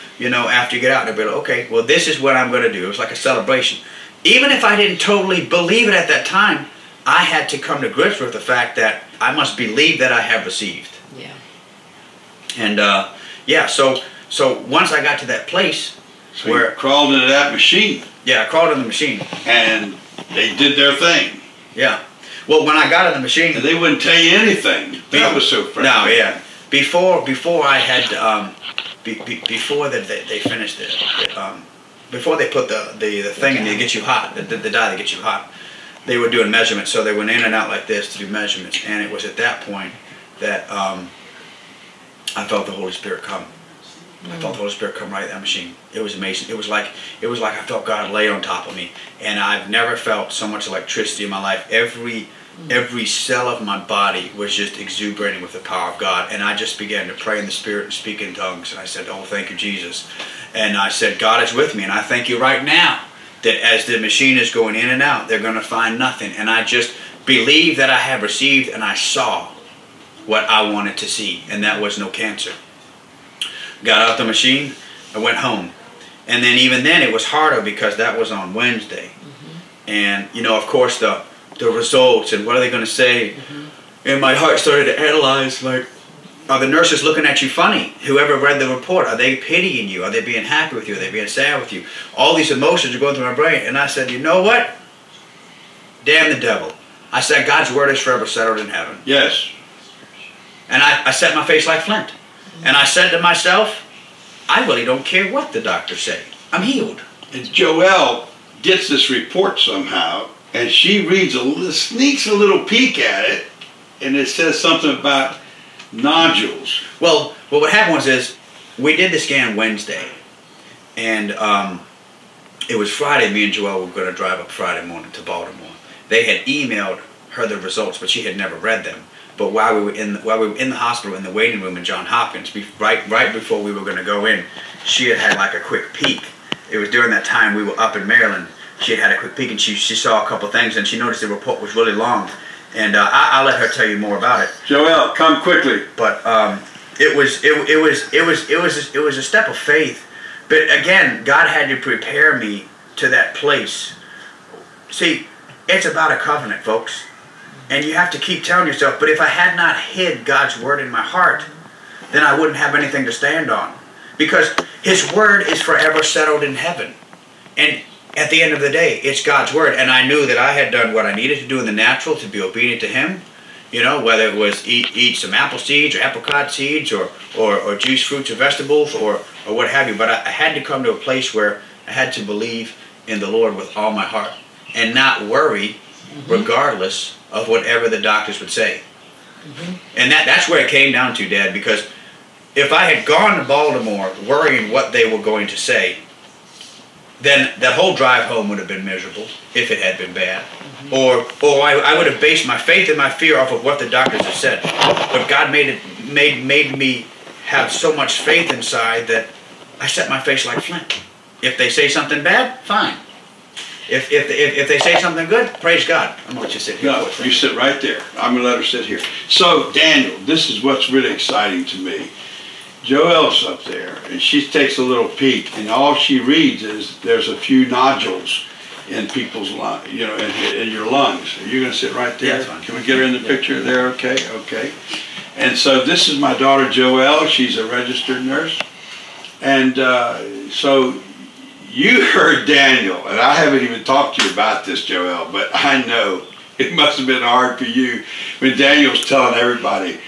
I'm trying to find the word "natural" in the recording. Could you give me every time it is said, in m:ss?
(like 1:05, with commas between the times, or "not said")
2:51.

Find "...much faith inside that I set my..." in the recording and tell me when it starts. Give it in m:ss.
3:27.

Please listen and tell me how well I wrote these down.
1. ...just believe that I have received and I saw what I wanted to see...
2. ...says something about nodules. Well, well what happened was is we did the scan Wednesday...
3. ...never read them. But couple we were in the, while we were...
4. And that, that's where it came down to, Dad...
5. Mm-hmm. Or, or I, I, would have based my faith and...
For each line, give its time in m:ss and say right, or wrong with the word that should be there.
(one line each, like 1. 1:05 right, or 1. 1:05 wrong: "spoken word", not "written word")
1. 1:06 right
2. 1:54 right
3. 2:08 wrong: "while", not "couple"
4. 3:09 right
5. 3:20 right.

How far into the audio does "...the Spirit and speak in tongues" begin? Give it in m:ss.
0:57.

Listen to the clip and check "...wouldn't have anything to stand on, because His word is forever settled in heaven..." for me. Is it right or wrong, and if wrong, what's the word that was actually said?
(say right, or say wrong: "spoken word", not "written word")
right.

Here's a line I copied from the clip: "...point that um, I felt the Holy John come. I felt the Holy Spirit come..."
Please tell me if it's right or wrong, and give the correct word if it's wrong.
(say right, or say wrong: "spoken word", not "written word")
wrong: "Spirit", not "John".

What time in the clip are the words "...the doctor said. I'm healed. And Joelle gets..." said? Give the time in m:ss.
1:45.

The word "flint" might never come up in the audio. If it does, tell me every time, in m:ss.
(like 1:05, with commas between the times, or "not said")
1:41, 3:30.